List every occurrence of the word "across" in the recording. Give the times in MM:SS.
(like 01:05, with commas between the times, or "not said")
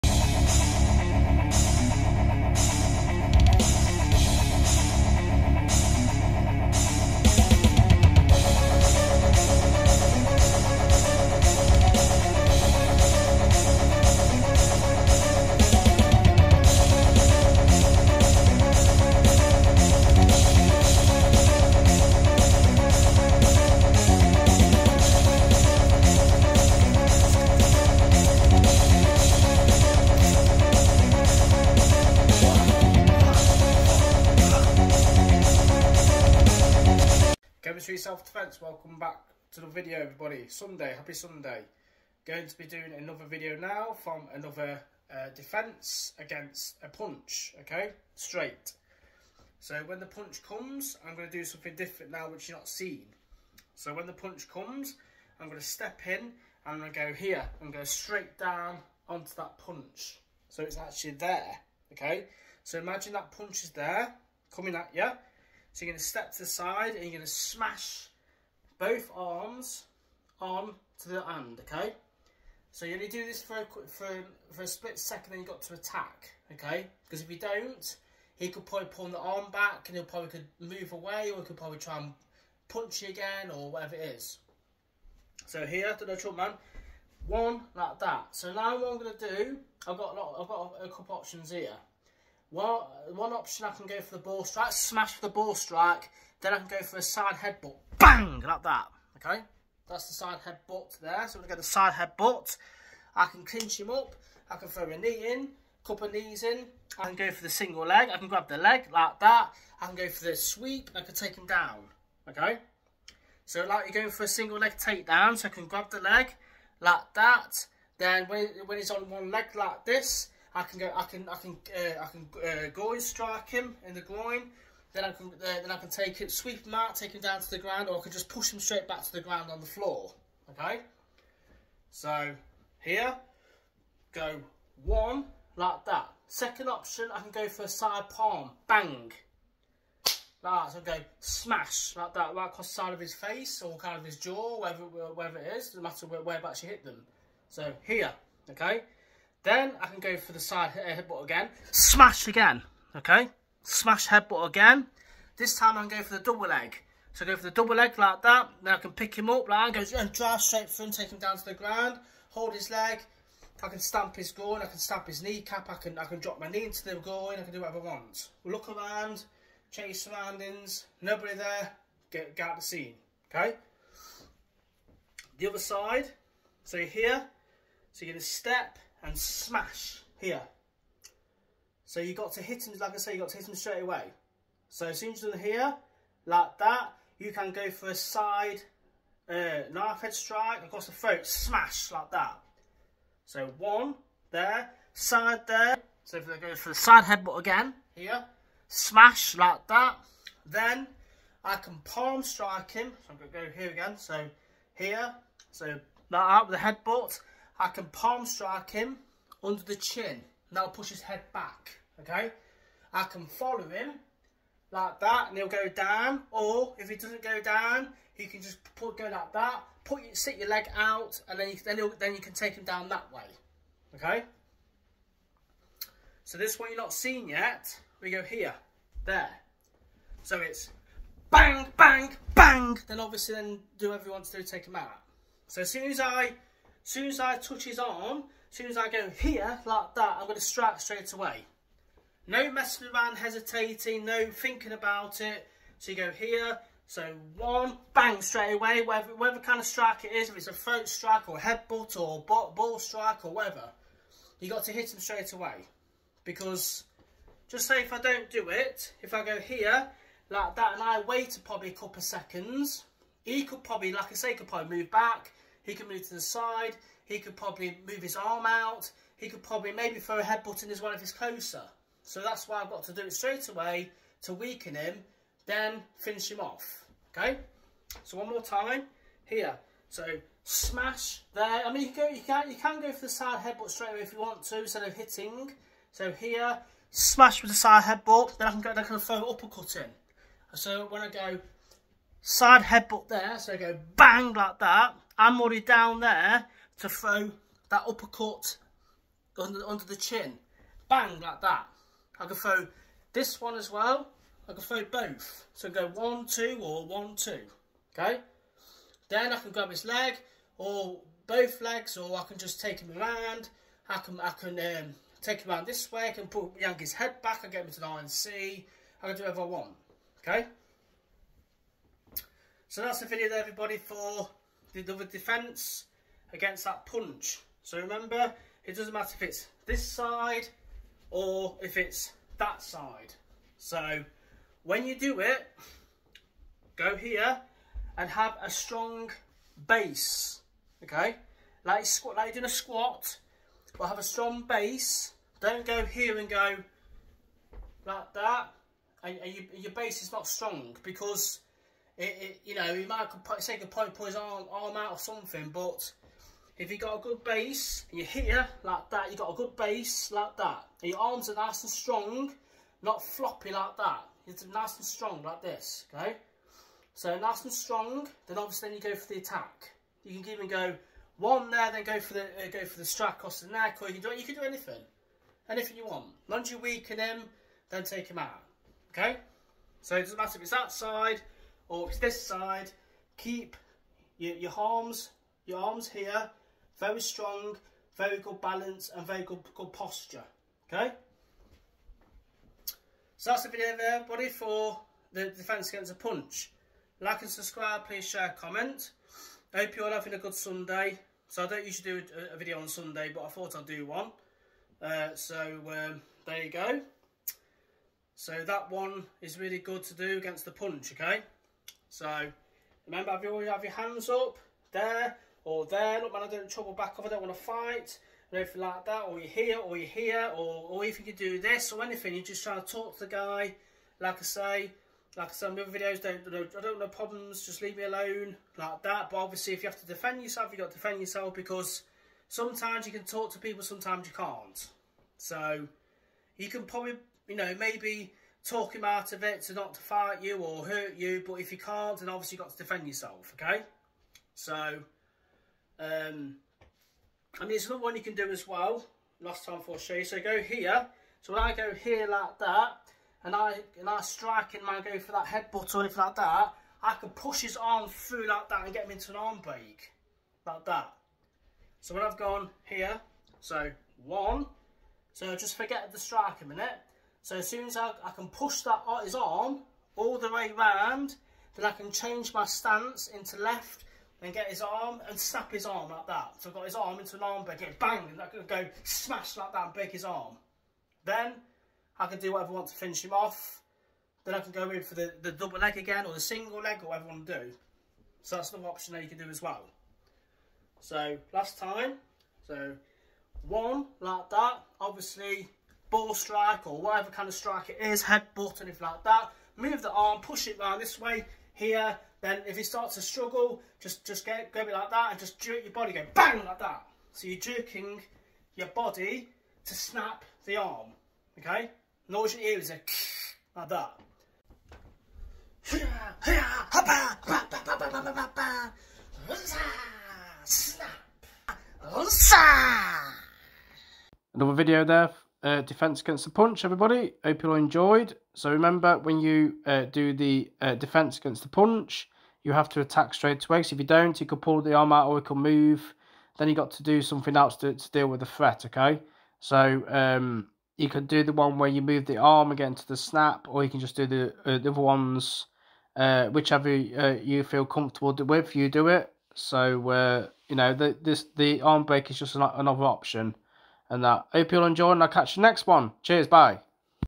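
02:22, 03:10, 06:13.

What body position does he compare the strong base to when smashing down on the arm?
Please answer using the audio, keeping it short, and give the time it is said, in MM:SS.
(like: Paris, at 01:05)
A squat, at 05:42.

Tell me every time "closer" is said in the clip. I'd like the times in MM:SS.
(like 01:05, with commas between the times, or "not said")
04:31.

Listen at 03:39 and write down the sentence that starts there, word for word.
Put your, sit your leg out and then you, then, then you can take him down that way, okay?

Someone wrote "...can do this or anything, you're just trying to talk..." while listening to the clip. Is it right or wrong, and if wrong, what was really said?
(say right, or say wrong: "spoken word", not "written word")
right.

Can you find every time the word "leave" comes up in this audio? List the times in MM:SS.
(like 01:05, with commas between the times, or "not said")
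07:07.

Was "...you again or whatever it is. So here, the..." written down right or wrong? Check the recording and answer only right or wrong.
right.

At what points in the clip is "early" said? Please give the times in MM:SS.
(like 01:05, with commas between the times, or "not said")
not said.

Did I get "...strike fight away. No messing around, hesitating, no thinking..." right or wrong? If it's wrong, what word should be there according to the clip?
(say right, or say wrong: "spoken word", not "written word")
wrong: "straight", not "fight".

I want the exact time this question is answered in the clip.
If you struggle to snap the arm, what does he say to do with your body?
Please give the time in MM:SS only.
08:25.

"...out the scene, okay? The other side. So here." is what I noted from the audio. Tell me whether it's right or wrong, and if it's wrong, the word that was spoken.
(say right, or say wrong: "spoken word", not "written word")
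right.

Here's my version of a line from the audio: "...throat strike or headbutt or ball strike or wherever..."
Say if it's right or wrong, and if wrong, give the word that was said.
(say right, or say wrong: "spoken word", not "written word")
wrong: "whatever", not "wherever".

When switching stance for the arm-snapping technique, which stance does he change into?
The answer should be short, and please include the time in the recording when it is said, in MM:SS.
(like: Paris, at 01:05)
Left, at 07:51.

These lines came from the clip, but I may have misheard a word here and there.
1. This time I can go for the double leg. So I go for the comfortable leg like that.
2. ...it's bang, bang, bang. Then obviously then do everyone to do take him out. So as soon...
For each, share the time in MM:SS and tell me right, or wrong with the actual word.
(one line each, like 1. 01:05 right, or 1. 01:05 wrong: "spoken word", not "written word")
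1. 02:35 wrong: "double", not "comfortable"
2. 03:50 right.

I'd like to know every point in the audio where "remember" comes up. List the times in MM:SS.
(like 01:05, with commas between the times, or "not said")
05:27, 06:52, 08:48.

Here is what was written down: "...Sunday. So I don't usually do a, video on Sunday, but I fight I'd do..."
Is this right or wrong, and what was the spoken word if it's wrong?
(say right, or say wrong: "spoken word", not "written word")
wrong: "thought", not "fight".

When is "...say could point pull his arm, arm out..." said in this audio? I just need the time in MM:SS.
05:53.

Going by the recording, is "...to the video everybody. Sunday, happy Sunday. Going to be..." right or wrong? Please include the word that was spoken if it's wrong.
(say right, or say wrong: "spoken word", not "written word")
right.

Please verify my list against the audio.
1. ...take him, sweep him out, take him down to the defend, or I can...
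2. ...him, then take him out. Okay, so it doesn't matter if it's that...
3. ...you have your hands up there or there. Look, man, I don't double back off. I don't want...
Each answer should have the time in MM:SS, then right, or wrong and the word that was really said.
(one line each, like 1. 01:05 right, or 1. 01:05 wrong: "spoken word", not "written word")
1. 02:05 wrong: "ground", not "defend"
2. 06:16 right
3. 06:53 wrong: "trouble", not "double".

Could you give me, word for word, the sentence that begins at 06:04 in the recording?
It's nice and strong like this, okay?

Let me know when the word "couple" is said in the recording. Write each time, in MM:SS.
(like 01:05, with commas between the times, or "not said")
01:30, 01:45, 04:21.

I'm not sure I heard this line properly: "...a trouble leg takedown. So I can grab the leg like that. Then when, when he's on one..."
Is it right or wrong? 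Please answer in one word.
wrong.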